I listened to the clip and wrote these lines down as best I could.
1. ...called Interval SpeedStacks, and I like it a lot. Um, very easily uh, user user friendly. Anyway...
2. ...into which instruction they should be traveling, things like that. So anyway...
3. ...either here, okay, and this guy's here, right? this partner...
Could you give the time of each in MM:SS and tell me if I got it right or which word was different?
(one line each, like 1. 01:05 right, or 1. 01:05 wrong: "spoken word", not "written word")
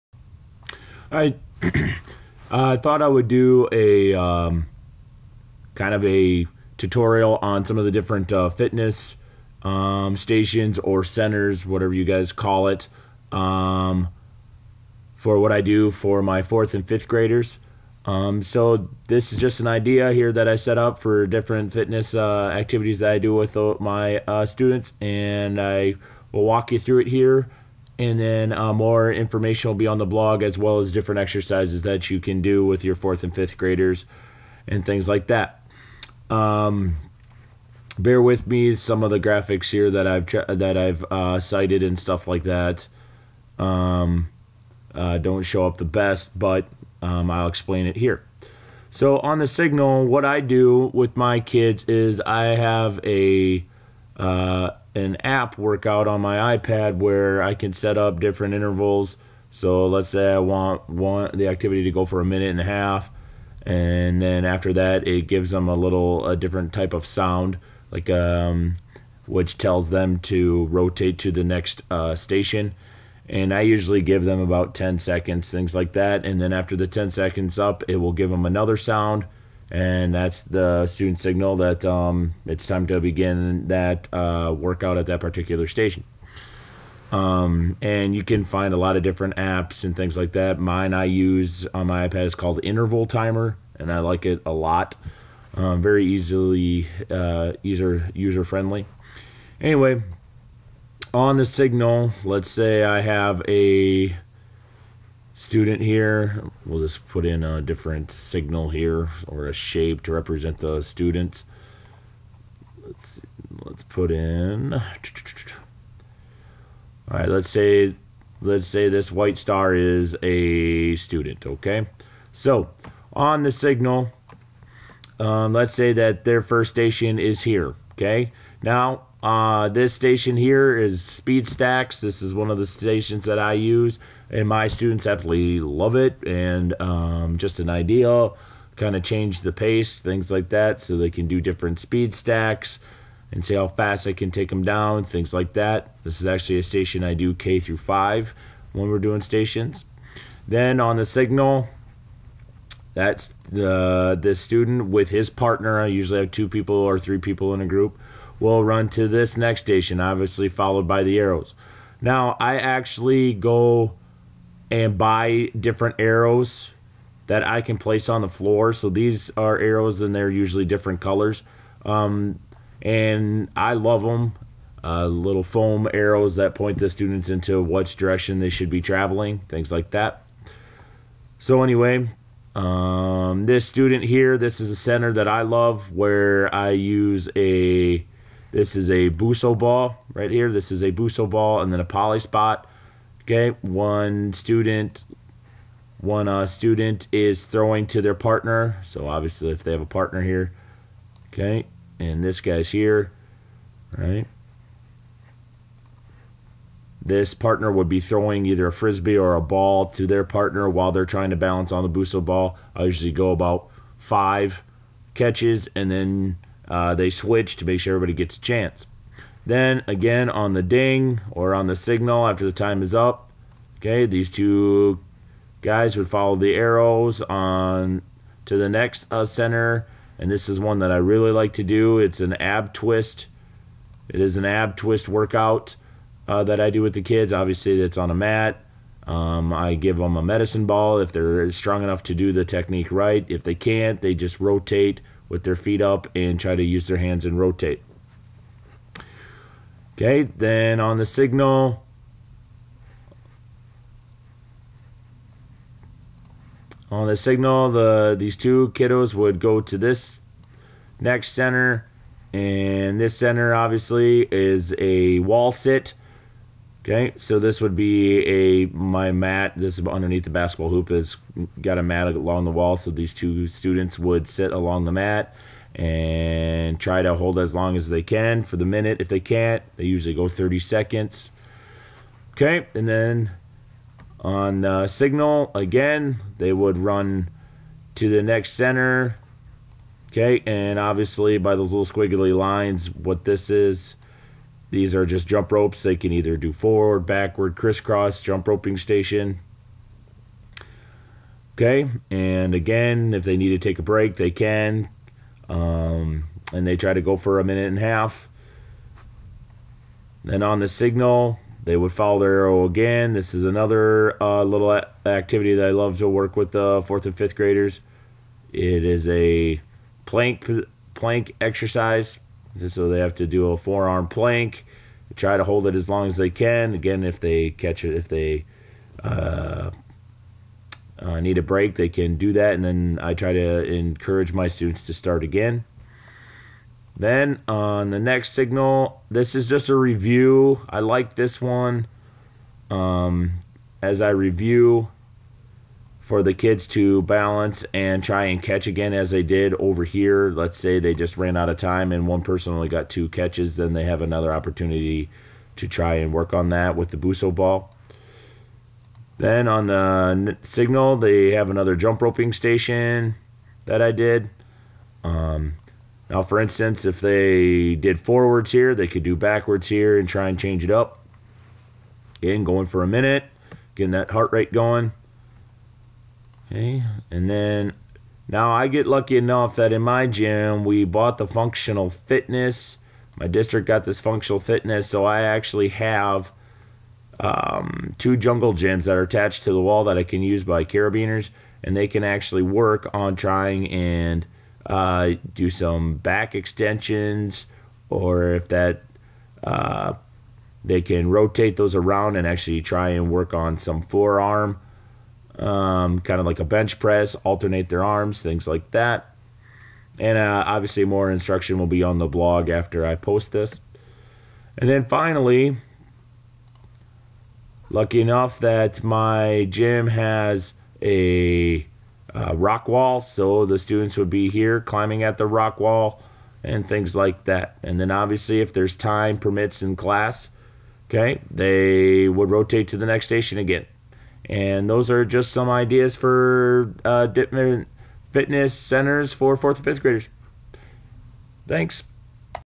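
1. 01:32 wrong: "Timer", not "SpeedStacks"
2. 02:57 wrong: "direction", not "instruction"
3. 03:19 wrong: "partner", not "either".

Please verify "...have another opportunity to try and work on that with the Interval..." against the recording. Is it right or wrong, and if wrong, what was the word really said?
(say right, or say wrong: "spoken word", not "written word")
wrong: "BOSU", not "Interval".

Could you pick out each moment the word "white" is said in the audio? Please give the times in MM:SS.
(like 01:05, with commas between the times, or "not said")
01:59.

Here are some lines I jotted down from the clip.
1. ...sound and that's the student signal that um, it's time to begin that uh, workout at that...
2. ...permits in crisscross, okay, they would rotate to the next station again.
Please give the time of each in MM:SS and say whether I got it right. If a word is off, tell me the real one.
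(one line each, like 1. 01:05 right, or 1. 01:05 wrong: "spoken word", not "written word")
1. 01:18 right
2. 07:09 wrong: "class", not "crisscross".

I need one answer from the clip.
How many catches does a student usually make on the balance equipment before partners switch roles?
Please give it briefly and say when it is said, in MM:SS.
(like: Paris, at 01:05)
5, at 03:33.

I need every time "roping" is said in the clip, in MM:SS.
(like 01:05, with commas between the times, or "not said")
04:58, 06:02.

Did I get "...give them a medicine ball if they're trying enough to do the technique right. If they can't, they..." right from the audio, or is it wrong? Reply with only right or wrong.
wrong.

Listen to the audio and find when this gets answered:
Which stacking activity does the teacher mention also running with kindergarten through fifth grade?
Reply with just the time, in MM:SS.
02:11.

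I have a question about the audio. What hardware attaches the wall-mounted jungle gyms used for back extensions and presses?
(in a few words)
carabiners.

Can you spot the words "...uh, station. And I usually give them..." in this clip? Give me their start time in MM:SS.
01:11.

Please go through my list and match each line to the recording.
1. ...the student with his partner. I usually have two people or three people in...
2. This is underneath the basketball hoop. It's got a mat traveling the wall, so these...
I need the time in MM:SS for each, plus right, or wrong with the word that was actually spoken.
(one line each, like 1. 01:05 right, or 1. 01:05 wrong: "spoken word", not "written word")
1. 02:34 right
2. 04:29 wrong: "along", not "traveling".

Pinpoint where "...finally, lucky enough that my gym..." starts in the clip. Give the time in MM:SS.
06:54.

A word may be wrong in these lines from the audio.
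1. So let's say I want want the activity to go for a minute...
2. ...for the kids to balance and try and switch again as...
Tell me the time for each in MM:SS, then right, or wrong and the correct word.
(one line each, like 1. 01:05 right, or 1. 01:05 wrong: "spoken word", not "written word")
1. 00:59 right
2. 05:46 wrong: "catch", not "switch".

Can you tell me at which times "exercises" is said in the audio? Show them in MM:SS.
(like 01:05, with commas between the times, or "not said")
00:31, 05:21.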